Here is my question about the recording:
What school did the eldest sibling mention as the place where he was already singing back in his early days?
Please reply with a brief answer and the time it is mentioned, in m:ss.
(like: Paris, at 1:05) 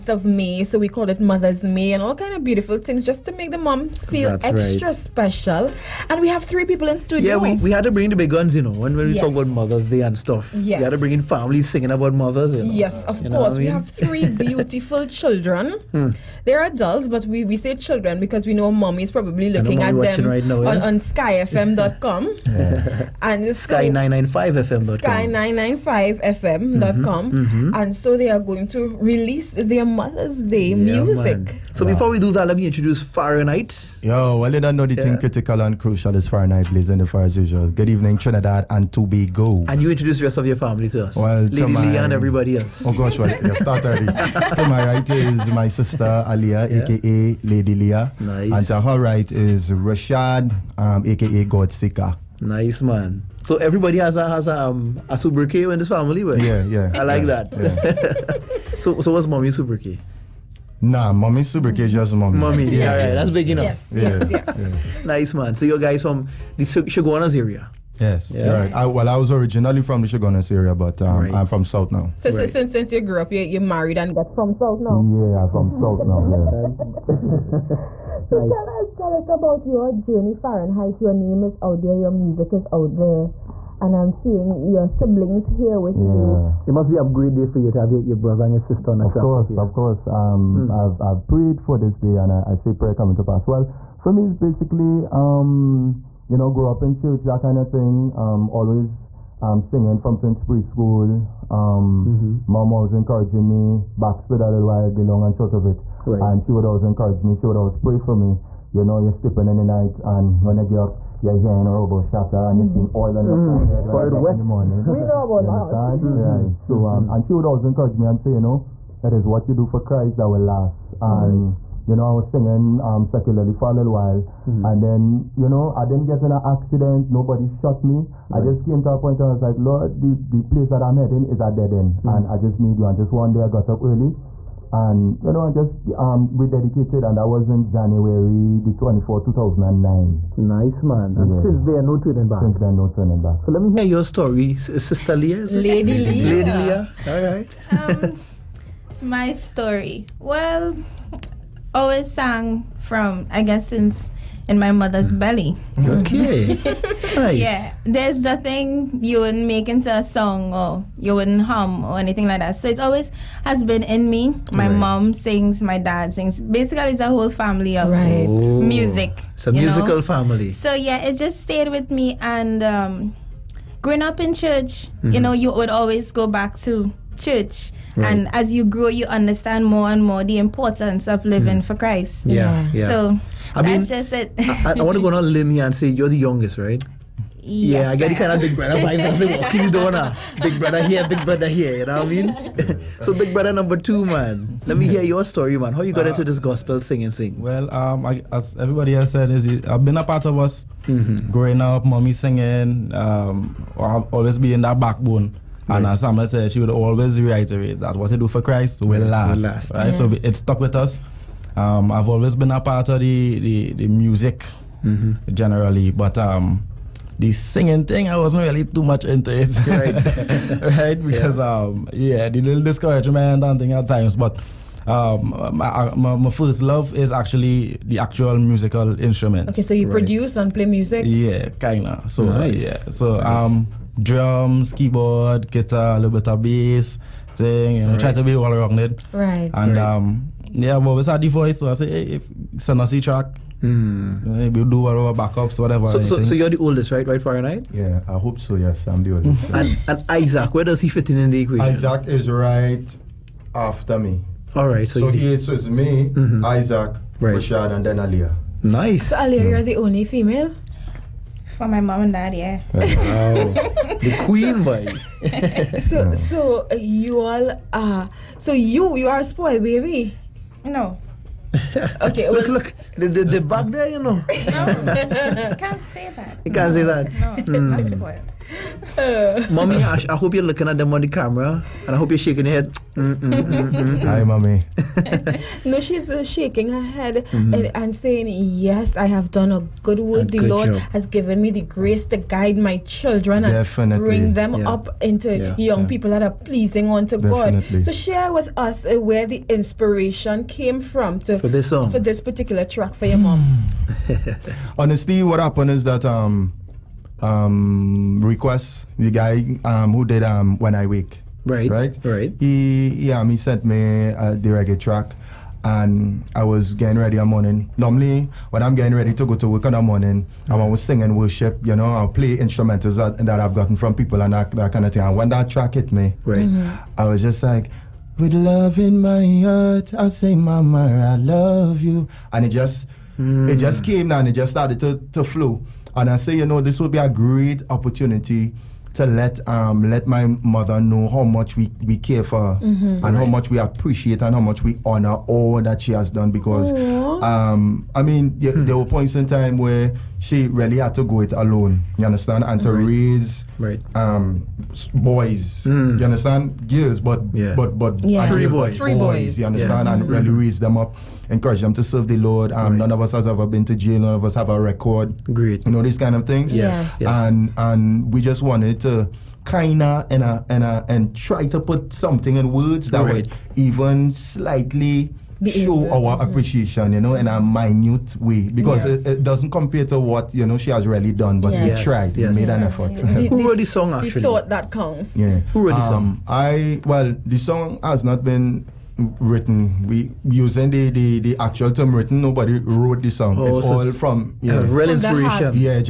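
Sainsbury School, at 1:40.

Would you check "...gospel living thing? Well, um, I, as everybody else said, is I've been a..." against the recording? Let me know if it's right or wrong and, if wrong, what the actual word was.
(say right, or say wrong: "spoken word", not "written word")
wrong: "singing", not "living".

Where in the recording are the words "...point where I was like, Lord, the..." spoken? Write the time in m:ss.
2:08.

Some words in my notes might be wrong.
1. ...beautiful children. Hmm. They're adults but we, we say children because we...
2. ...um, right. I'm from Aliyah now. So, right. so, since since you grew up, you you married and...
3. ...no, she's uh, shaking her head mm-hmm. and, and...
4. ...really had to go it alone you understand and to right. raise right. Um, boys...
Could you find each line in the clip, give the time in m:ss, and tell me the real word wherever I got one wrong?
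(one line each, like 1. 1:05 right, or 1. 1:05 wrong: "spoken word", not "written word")
1. 0:14 right
2. 1:11 wrong: "South", not "Aliyah"
3. 4:45 right
4. 5:50 right.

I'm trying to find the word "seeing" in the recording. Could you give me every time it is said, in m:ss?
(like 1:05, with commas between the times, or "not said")
1:24, 1:52.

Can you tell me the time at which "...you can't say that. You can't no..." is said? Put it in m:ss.
4:34.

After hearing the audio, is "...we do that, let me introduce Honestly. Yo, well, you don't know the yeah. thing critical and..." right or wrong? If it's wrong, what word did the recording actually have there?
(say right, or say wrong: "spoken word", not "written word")
wrong: "Farenite", not "Honestly".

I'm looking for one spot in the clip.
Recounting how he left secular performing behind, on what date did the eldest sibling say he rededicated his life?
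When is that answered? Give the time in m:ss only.
2:17.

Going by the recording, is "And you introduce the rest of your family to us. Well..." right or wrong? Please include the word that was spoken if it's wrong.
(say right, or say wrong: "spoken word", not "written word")
right.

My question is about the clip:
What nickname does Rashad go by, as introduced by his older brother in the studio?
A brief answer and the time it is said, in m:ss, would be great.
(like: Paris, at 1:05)
God Seeker, at 0:51.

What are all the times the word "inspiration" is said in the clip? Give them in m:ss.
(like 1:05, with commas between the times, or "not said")
4:59, 6:34.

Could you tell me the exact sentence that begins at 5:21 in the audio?
You know, I'll play instrumentals that, that I've gotten from people and that, that kind of thing.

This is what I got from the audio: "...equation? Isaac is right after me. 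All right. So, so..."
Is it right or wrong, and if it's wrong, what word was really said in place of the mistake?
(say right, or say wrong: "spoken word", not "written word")
right.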